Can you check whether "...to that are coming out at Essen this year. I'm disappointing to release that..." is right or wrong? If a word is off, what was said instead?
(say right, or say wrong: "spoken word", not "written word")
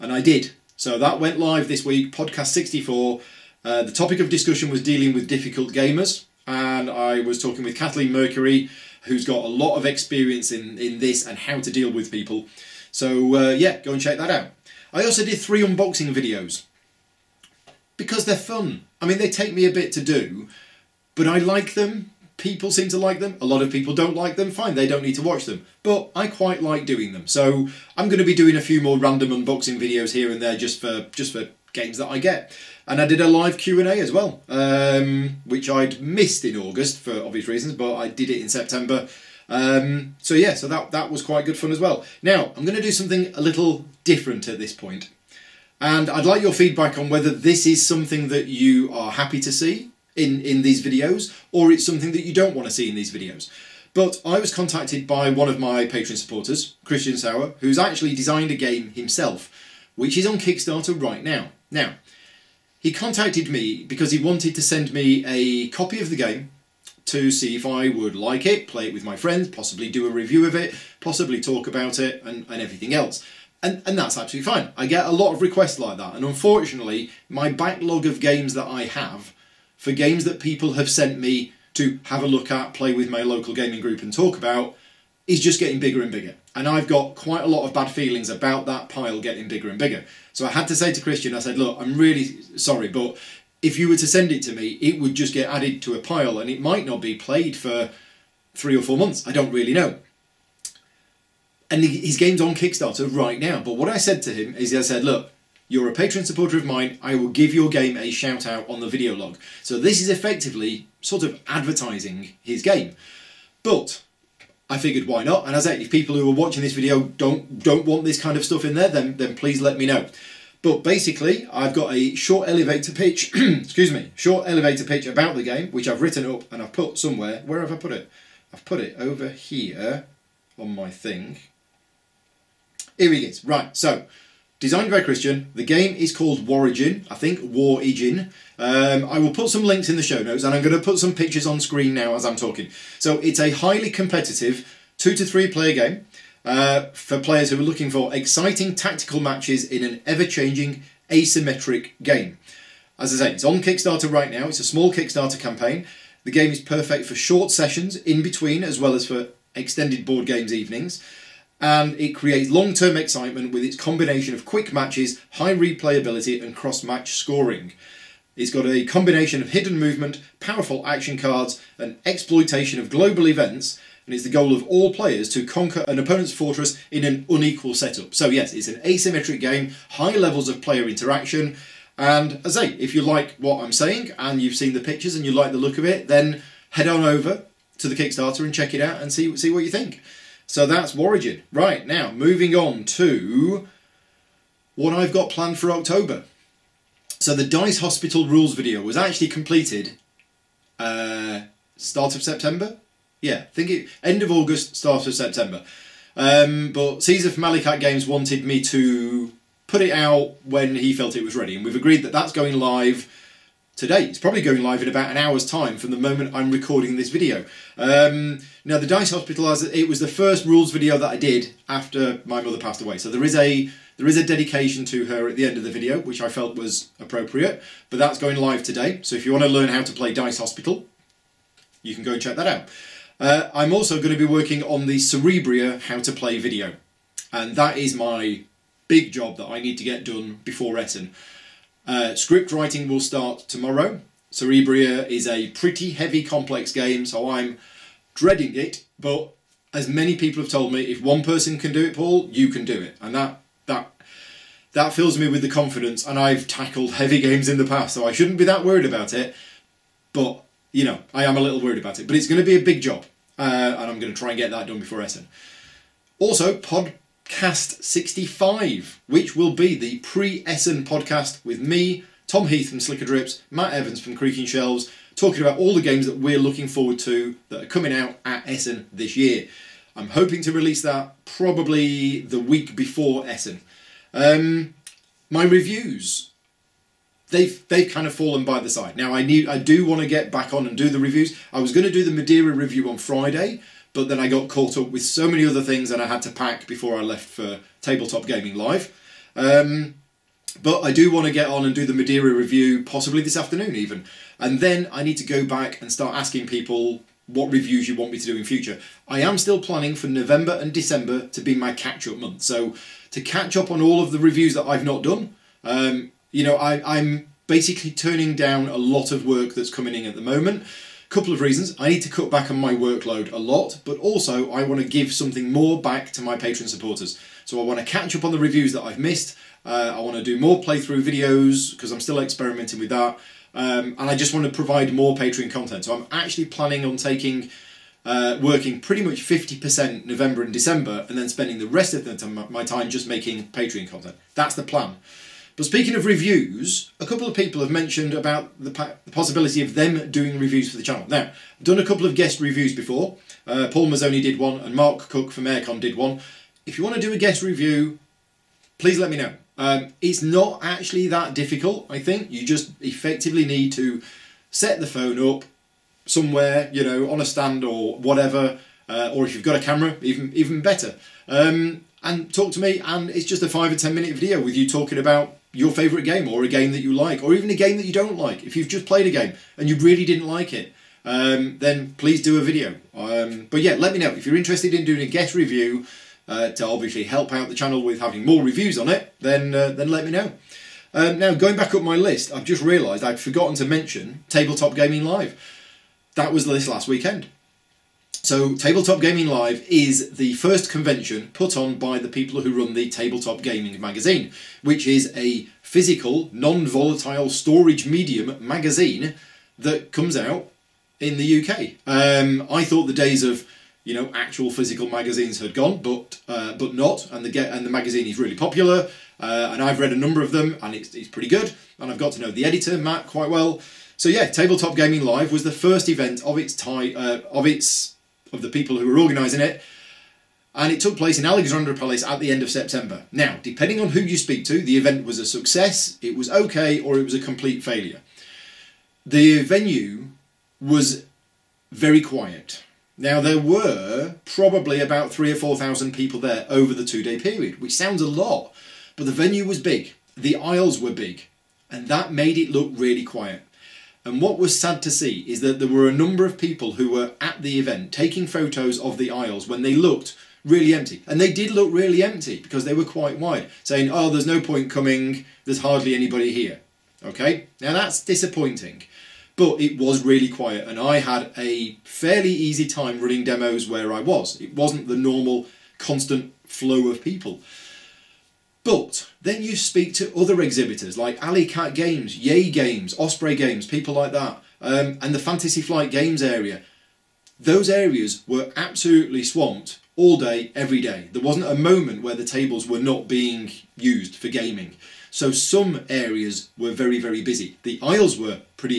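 wrong: "hoping", not "disappointing".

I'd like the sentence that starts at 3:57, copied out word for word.
And that is my big job that I need to get done before Essen.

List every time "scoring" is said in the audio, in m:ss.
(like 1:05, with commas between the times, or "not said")
2:47.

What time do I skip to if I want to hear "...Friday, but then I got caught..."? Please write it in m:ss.
4:52.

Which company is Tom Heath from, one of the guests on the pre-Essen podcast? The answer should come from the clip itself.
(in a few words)
Slickerdrips.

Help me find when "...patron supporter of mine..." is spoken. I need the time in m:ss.
1:45.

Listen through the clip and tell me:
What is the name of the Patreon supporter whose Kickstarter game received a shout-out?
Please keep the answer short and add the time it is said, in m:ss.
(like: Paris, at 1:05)
Christian Sauer, at 0:56.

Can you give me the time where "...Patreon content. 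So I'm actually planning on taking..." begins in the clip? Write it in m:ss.
5:35.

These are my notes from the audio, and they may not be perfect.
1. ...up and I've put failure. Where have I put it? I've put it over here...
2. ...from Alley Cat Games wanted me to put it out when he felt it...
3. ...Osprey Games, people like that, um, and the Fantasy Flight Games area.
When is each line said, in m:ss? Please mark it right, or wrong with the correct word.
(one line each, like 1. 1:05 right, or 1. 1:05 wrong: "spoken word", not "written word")
1. 2:06 wrong: "somewhere", not "failure"
2. 3:27 right
3. 8:02 right.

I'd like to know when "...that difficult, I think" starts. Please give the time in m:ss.
6:01.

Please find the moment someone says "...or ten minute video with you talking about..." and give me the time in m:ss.
6:13.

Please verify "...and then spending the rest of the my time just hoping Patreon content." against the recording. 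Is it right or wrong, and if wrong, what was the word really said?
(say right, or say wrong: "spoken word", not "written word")
wrong: "making", not "hoping".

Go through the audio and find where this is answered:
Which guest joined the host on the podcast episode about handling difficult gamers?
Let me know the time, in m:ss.
0:07.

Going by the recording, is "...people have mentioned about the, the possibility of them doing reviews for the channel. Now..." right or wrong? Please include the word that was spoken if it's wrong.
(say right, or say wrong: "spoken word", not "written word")
right.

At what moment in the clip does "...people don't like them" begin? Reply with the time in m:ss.
0:23.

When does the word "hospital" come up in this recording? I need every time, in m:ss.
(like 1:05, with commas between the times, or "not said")
3:17, 3:39, 3:50.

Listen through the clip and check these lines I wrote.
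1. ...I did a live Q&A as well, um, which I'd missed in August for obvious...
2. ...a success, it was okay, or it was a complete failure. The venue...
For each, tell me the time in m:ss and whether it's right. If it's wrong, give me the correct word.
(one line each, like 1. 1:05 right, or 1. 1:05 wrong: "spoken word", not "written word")
1. 0:33 right
2. 7:15 right.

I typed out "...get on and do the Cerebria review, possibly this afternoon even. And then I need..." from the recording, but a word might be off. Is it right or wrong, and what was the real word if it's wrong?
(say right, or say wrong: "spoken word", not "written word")
wrong: "Madeira", not "Cerebria".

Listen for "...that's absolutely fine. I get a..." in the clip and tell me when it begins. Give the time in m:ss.
1:13.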